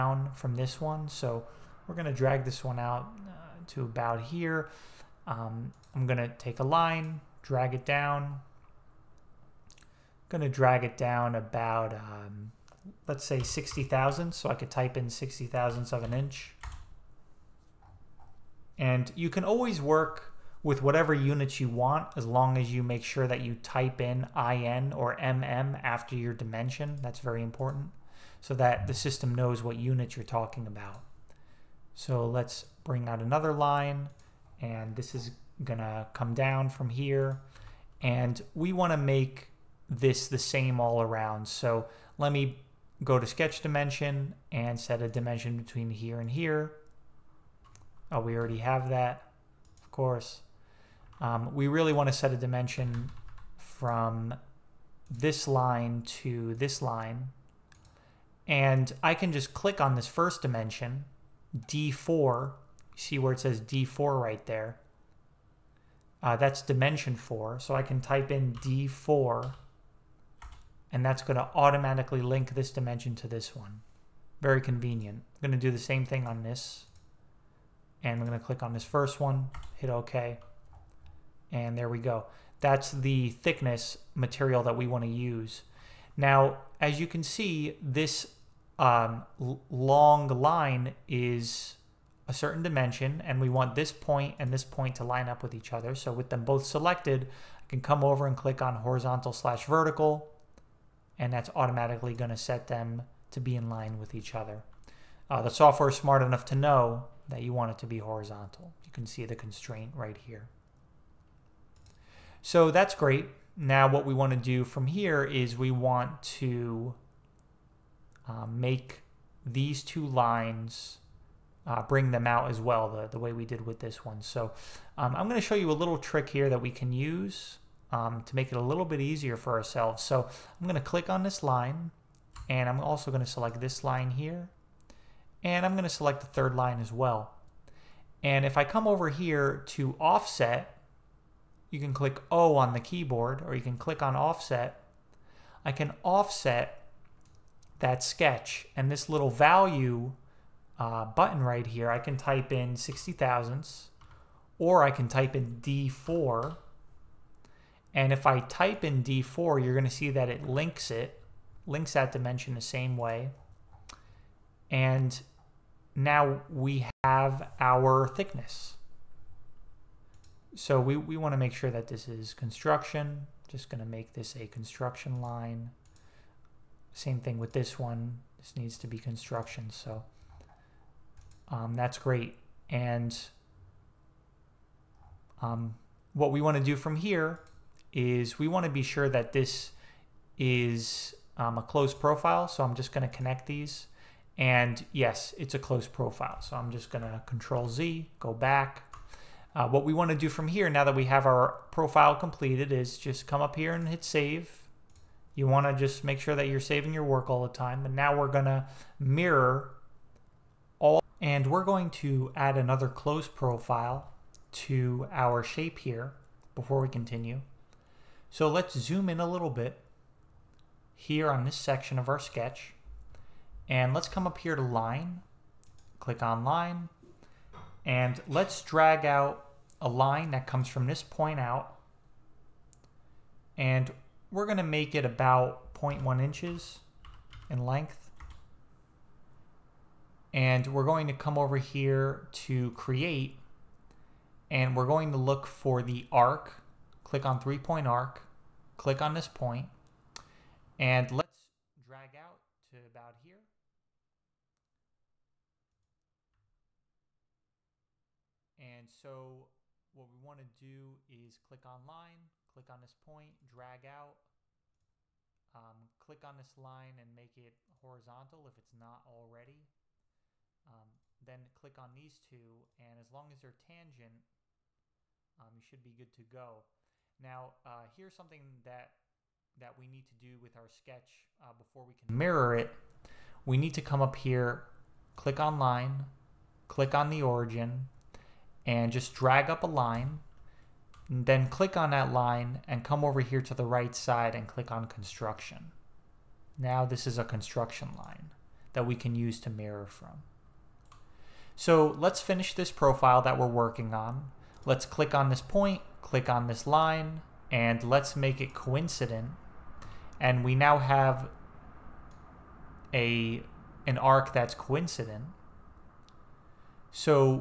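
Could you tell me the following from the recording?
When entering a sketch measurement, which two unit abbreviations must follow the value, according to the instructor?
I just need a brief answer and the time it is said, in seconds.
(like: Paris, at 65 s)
IN or MM, at 24 s.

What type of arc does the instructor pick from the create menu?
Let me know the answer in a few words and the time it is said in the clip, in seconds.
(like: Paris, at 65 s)
three point arc, at 247 s.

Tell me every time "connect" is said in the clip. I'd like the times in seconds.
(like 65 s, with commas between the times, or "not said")
193 s.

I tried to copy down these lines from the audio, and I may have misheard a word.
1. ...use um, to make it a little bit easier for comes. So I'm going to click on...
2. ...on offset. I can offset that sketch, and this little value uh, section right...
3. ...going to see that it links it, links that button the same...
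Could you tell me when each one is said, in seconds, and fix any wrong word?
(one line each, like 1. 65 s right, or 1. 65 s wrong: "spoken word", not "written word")
1. 126 s wrong: "ourselves", not "comes"
2. 144 s wrong: "button", not "section"
3. 159 s wrong: "dimension", not "button".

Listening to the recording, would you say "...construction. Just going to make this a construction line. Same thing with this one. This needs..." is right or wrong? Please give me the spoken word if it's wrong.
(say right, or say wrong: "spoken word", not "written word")
right.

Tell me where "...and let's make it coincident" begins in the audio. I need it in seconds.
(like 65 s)
307 s.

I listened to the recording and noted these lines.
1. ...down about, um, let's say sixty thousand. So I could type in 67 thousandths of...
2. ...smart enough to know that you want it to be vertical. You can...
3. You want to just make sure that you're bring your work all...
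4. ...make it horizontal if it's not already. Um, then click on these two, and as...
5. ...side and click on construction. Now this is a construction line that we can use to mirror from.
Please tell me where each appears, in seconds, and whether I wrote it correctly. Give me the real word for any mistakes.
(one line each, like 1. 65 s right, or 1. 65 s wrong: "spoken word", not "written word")
1. 10 s wrong: "60", not "67"
2. 105 s wrong: "horizontal", not "vertical"
3. 205 s wrong: "saving", not "bring"
4. 267 s right
5. 293 s right.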